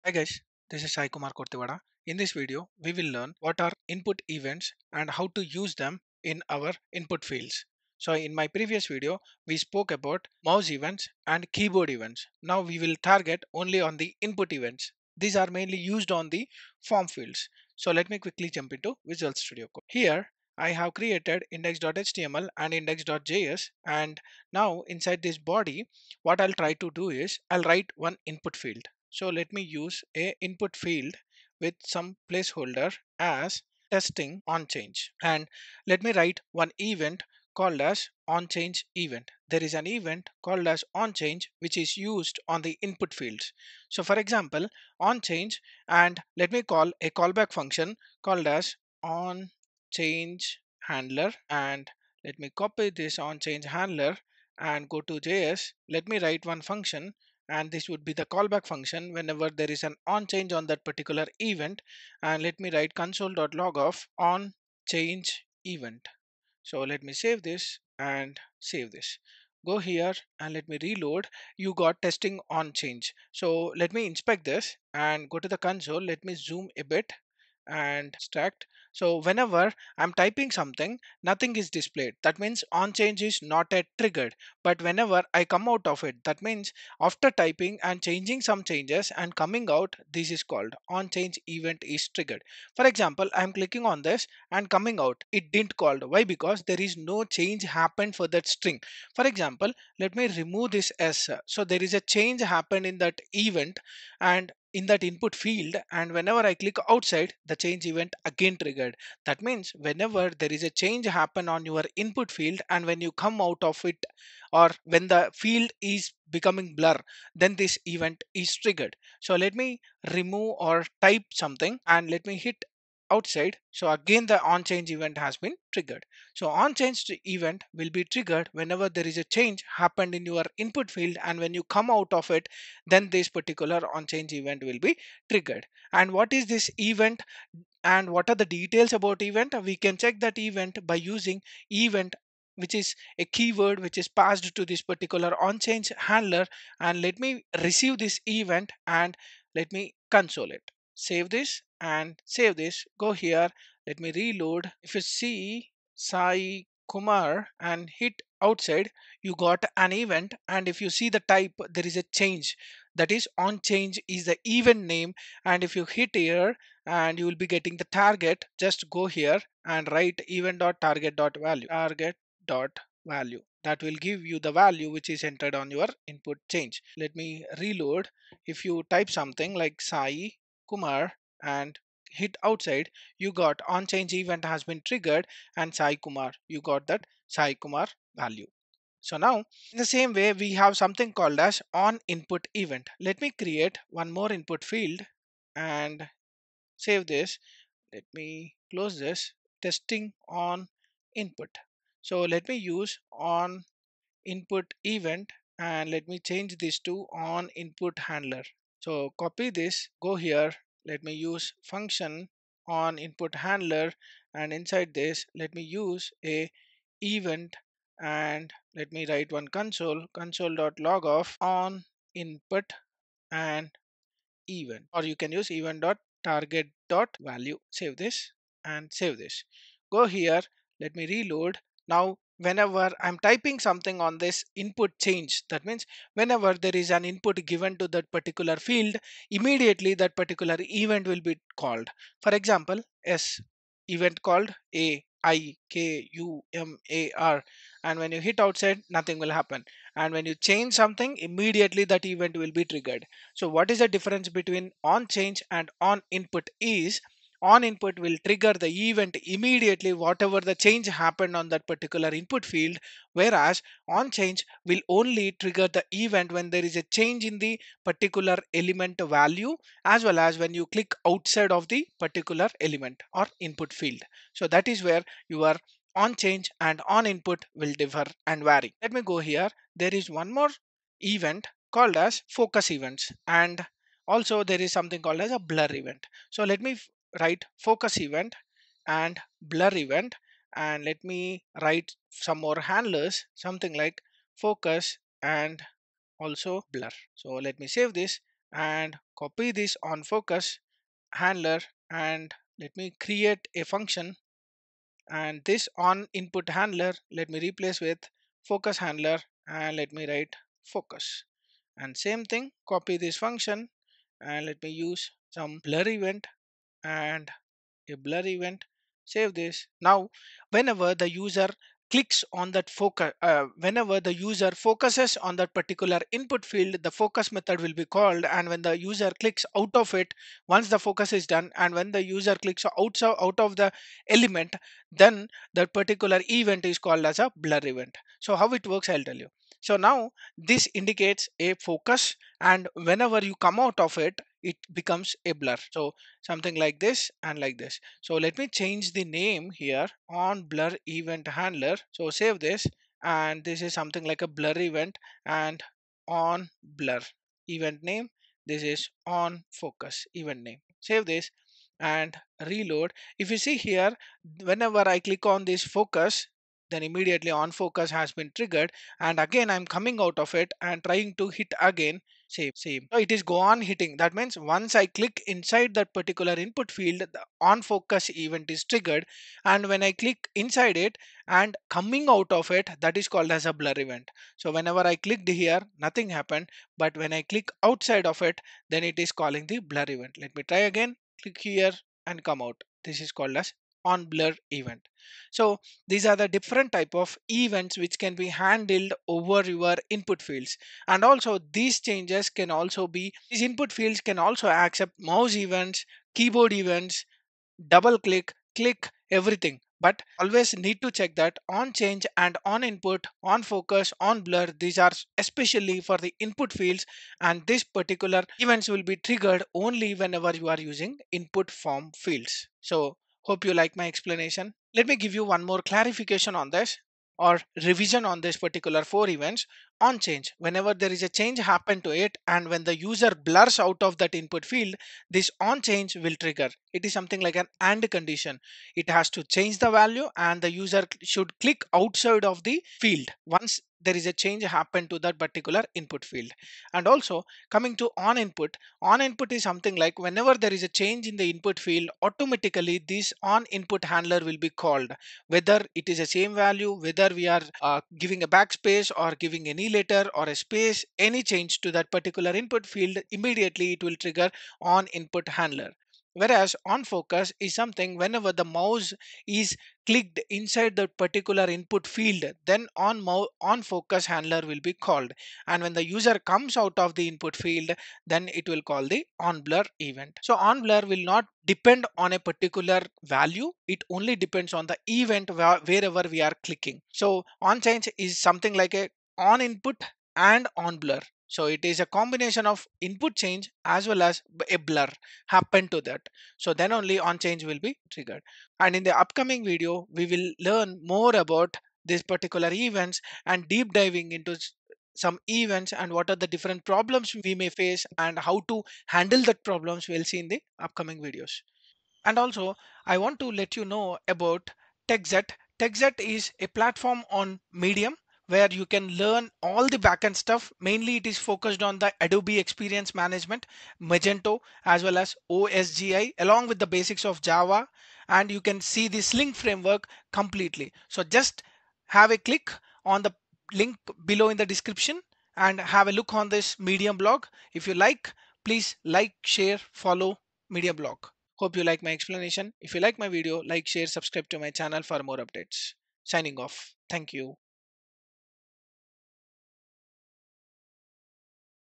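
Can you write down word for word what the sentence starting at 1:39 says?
For example, let me remove this S.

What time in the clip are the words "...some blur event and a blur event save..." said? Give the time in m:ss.
5:15.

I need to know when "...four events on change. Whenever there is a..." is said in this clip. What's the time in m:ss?
7:08.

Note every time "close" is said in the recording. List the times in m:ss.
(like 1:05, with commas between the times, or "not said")
3:18.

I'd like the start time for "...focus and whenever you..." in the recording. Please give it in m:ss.
5:41.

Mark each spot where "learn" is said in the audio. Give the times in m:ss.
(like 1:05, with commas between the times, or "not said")
0:03, 8:20, 8:38.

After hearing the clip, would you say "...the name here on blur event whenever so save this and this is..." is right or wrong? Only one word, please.
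wrong.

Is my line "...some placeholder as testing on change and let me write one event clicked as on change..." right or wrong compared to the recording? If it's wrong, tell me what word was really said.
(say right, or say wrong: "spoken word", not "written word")
wrong: "called", not "clicked".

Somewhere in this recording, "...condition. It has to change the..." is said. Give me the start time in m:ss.
7:17.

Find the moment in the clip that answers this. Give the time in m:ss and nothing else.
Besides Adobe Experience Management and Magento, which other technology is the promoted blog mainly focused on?
8:45.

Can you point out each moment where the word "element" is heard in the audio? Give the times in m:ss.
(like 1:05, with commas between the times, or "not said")
4:28, 4:32, 5:34.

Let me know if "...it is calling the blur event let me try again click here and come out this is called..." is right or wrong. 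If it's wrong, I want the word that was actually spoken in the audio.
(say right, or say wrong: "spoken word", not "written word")
right.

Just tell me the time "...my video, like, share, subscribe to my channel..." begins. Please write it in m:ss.
9:02.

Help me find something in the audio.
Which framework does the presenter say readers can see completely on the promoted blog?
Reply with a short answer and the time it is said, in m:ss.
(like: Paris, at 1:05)
Sling framework, at 8:49.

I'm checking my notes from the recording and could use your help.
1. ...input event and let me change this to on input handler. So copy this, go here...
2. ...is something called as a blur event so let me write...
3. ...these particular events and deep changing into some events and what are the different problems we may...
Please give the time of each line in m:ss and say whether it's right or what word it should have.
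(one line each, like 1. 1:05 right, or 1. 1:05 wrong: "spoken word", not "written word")
1. 3:24 right
2. 4:44 right
3. 8:21 wrong: "diving", not "changing".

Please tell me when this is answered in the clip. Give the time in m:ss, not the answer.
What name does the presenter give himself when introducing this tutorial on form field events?
0:00.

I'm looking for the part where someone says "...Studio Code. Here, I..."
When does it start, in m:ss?
0:19.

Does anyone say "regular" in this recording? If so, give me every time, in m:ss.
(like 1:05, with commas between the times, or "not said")
not said.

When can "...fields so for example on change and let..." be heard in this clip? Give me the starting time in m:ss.
0:43.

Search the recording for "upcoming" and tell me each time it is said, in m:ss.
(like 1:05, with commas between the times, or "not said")
8:19, 8:30.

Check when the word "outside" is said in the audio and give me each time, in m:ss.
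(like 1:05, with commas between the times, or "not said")
1:46, 2:03, 2:38, 3:02, 4:08, 4:31, 6:27, 7:21.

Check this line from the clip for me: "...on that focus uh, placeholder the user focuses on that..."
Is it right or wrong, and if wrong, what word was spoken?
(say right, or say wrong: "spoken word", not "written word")
wrong: "whenever", not "placeholder".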